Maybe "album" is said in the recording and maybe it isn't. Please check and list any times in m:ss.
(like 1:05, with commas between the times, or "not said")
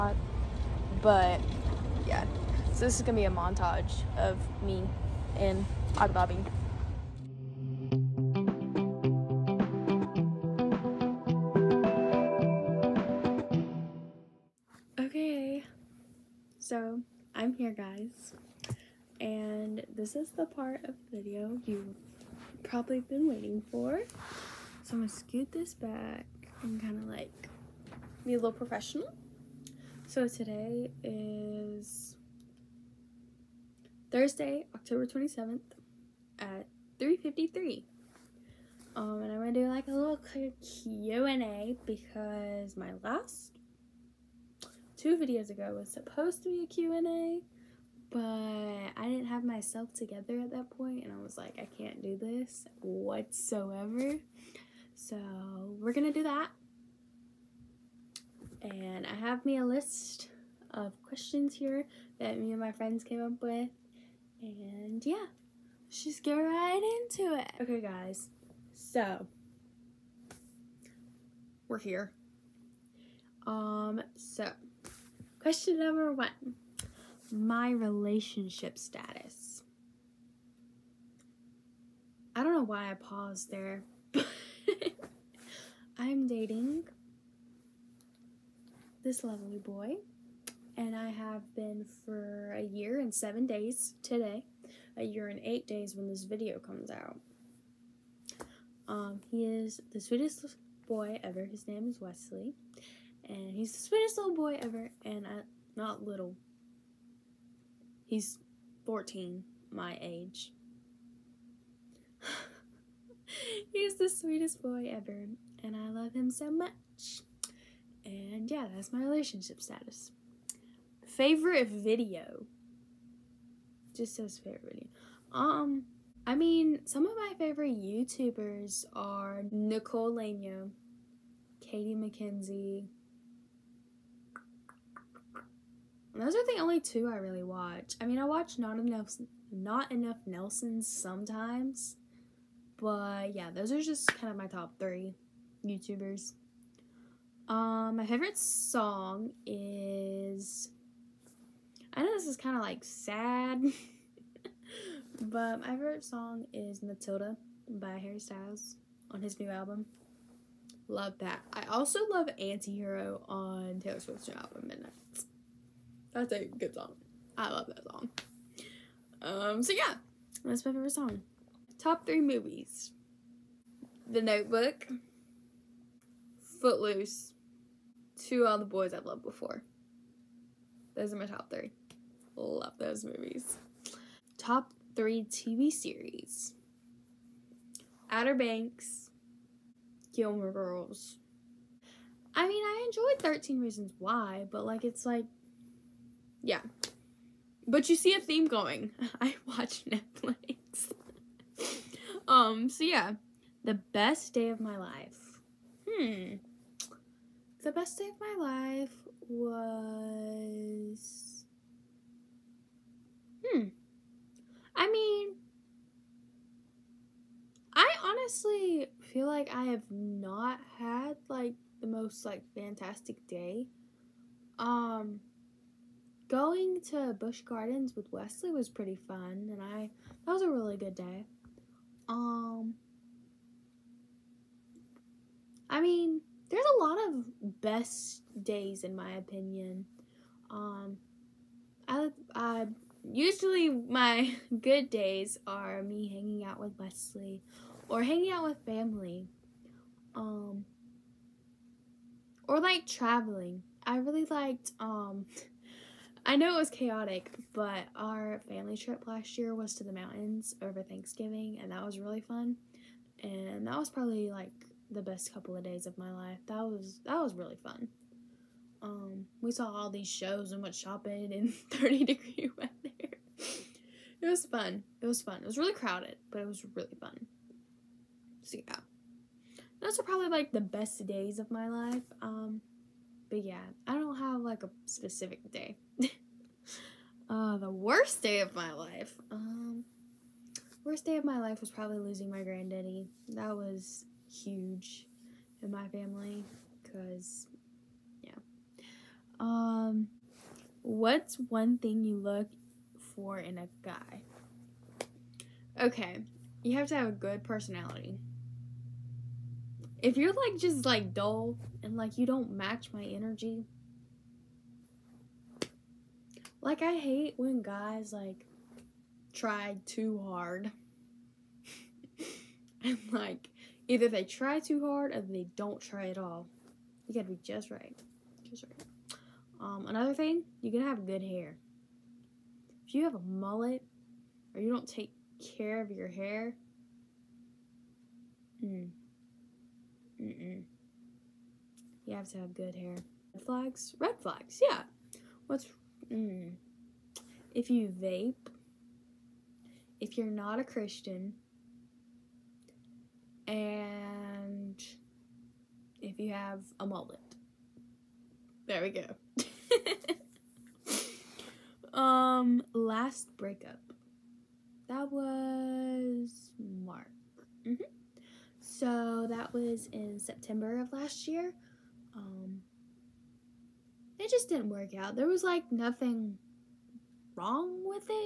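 2:39, 2:44.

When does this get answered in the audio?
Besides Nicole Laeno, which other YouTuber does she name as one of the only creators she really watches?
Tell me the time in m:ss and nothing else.
2:11.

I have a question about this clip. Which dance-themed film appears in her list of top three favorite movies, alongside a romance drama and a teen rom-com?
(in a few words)
Footloose.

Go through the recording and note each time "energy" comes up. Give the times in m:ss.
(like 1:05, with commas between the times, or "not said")
5:13.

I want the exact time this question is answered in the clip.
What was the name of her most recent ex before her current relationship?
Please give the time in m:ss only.
6:06.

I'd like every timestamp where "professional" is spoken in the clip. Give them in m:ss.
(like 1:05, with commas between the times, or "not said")
0:28.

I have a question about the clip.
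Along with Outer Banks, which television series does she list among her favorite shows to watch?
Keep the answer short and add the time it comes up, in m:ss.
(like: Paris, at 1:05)
Gilmore Girls, at 3:10.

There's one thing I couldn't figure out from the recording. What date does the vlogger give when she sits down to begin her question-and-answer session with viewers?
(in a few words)
October 27th.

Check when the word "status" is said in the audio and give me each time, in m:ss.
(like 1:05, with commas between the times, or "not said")
1:18, 1:59.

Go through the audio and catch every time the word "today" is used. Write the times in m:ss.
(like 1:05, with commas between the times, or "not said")
0:30, 1:34.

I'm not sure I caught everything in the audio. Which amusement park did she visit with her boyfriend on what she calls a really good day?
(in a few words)
Busch Gardens.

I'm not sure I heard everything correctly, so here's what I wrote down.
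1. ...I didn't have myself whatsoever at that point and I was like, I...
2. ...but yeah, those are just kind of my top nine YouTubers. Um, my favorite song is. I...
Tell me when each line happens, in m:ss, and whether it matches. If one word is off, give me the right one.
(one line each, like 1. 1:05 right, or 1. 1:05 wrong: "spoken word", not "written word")
1. 0:48 wrong: "together", not "whatsoever"
2. 2:22 wrong: "three", not "nine".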